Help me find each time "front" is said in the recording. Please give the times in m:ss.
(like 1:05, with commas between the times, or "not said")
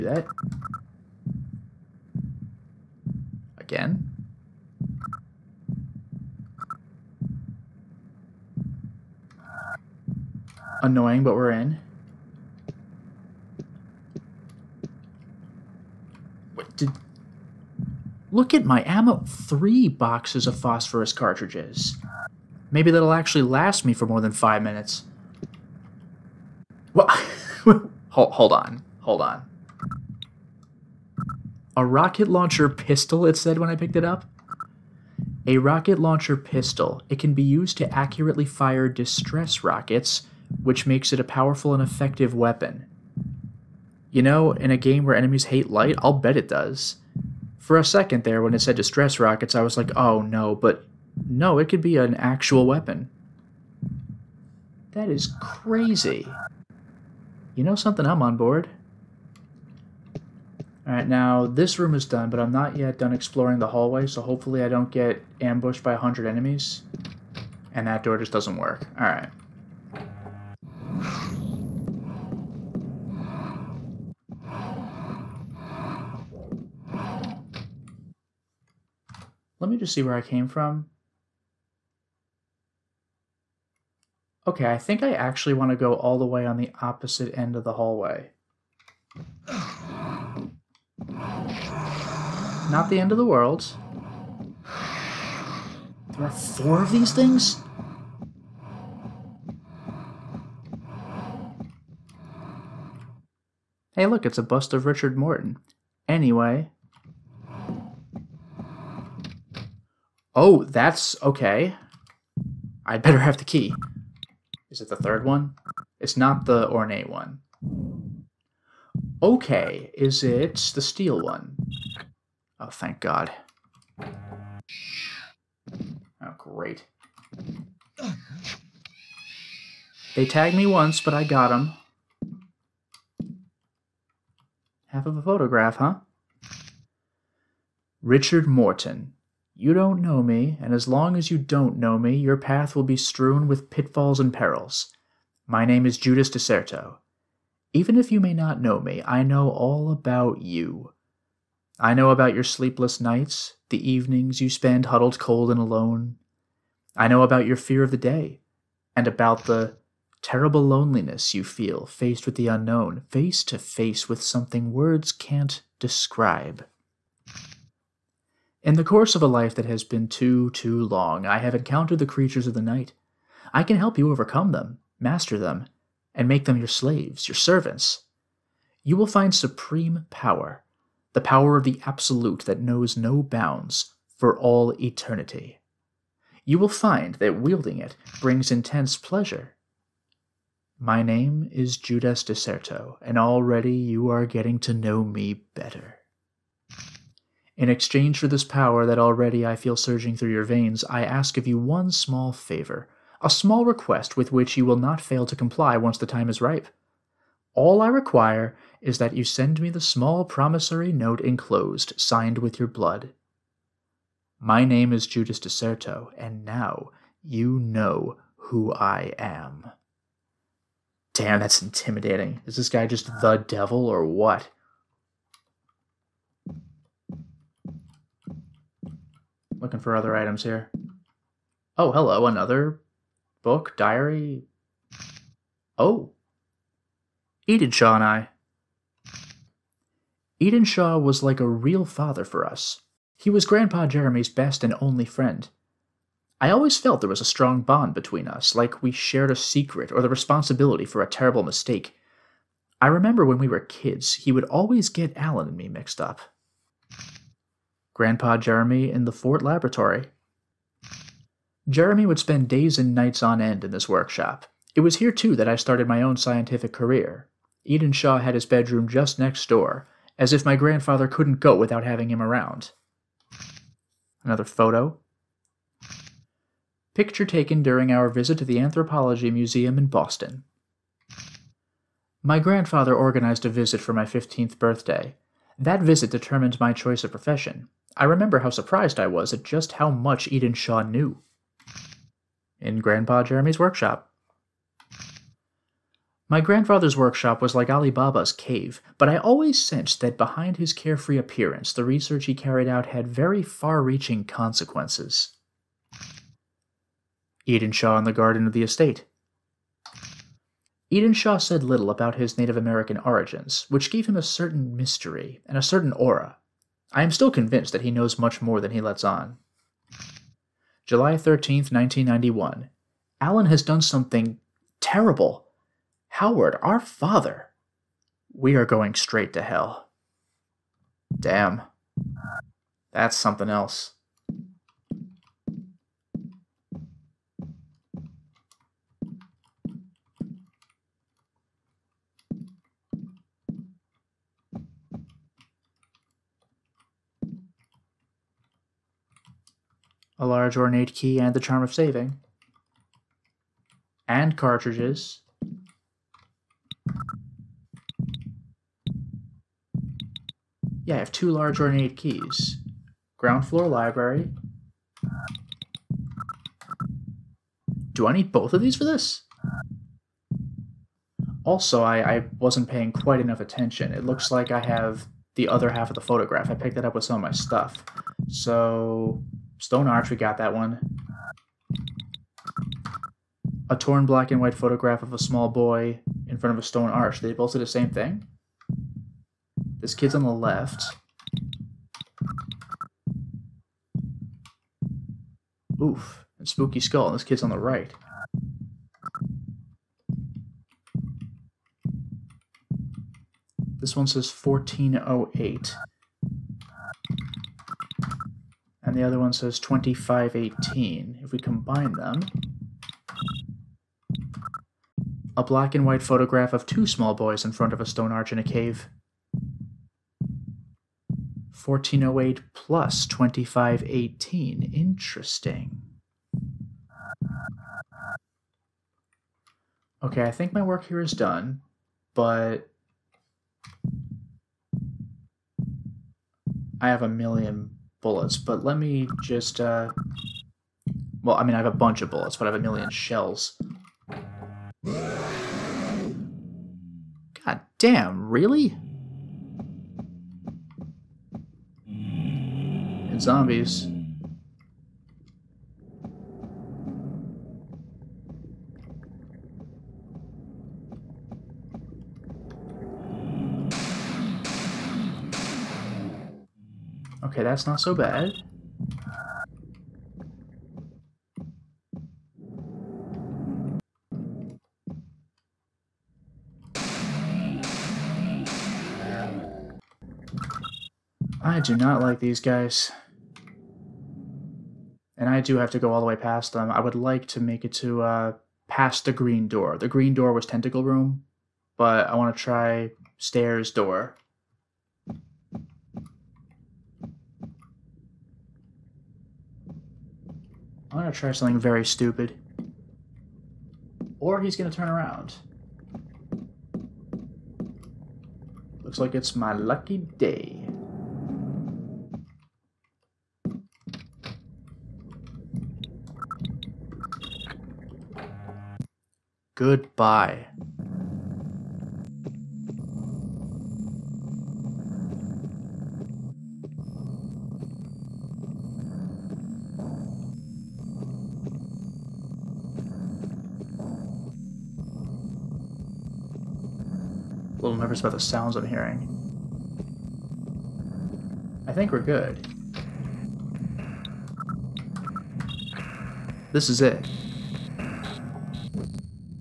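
6:26, 6:57.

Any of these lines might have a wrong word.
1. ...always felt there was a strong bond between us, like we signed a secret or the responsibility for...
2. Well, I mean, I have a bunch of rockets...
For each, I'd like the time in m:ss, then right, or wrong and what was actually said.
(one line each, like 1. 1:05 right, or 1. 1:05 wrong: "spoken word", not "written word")
1. 4:06 wrong: "shared", not "signed"
2. 7:21 wrong: "bullets", not "rockets".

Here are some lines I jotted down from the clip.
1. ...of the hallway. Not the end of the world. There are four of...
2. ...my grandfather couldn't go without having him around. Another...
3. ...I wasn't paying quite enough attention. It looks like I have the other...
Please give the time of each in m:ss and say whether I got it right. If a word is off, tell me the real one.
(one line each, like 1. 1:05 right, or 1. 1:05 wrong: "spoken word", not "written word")
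1. 1:27 right
2. 4:30 right
3. 6:12 right.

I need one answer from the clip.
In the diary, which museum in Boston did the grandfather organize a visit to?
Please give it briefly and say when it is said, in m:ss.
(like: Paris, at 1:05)
Anthropology Museum, at 4:38.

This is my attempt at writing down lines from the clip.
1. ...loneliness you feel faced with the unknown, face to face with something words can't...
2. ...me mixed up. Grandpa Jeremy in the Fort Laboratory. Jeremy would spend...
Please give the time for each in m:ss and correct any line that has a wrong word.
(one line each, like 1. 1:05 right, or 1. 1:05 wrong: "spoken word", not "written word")
1. 2:40 right
2. 4:15 right.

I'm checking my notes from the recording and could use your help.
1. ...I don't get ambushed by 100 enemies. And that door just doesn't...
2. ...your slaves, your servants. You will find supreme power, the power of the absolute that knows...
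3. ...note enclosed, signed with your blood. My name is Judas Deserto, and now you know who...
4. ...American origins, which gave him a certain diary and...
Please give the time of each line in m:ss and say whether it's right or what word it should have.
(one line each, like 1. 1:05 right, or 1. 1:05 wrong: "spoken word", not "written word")
1. 1:04 right
2. 2:56 right
3. 3:30 right
4. 5:12 wrong: "mystery", not "diary".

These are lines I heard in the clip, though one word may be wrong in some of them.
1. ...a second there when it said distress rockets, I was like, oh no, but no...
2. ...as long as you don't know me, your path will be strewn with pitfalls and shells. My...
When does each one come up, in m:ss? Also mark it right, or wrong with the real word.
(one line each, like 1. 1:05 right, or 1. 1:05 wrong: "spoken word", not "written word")
1. 0:47 right
2. 2:20 wrong: "perils", not "shells".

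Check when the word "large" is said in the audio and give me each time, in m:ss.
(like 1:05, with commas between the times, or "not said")
5:50, 6:01.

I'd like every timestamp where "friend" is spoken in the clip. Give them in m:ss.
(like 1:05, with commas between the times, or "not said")
4:05.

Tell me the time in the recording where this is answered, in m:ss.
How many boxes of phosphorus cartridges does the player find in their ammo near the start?
0:19.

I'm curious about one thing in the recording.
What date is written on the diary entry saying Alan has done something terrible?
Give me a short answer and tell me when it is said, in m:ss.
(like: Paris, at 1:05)
July 13th, 1991, at 5:20.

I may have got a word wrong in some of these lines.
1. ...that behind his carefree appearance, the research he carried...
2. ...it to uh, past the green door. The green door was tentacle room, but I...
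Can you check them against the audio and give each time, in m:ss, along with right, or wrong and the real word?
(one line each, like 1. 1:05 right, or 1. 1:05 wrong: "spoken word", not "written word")
1. 4:59 right
2. 8:07 right.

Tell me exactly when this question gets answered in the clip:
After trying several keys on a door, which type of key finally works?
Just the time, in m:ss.
2:00.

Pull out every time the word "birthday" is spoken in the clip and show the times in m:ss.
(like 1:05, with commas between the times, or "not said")
4:44.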